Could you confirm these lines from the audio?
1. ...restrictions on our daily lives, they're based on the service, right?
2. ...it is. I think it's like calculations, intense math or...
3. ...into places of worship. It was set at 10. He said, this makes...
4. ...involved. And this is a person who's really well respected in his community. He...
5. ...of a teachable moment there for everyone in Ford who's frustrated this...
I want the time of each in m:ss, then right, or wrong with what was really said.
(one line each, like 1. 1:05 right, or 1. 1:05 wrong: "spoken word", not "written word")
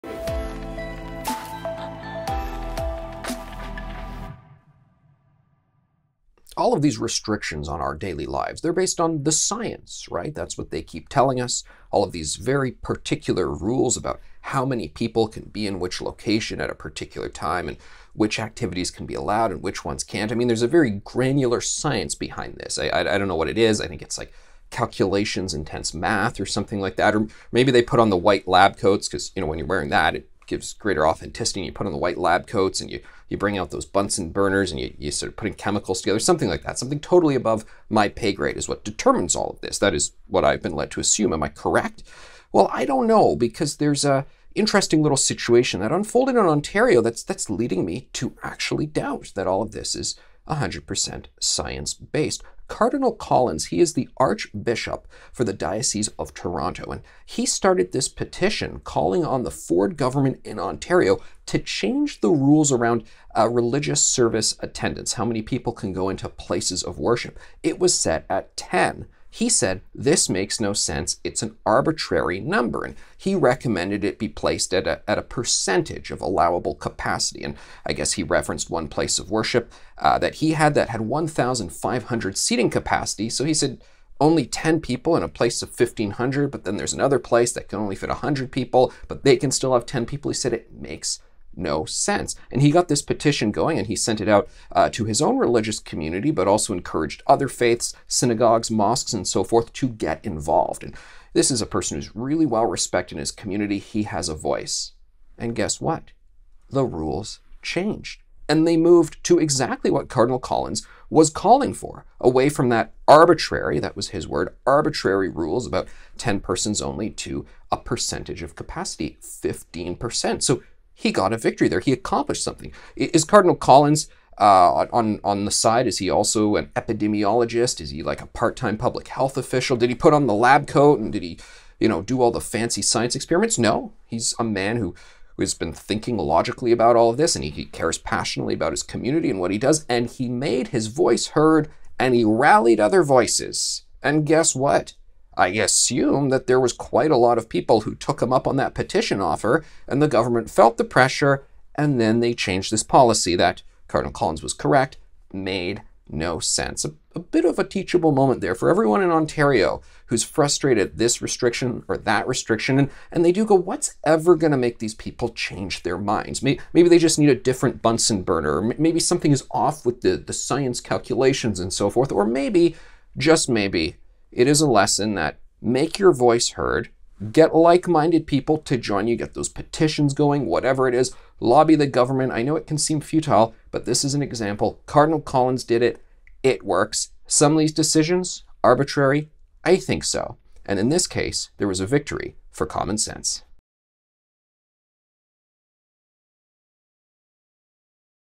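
1. 0:06 wrong: "science", not "service"
2. 0:23 right
3. 1:06 right
4. 1:40 right
5. 2:37 wrong: "Ontario", not "Ford".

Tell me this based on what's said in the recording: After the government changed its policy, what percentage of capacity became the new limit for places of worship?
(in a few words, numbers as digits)
15%.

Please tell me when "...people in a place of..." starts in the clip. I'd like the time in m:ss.
1:24.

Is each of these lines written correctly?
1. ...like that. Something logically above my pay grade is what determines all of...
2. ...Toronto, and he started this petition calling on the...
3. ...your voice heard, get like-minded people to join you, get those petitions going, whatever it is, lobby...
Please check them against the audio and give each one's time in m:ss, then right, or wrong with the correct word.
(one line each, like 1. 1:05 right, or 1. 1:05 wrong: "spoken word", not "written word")
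1. 0:36 wrong: "totally", not "logically"
2. 0:56 right
3. 2:55 right.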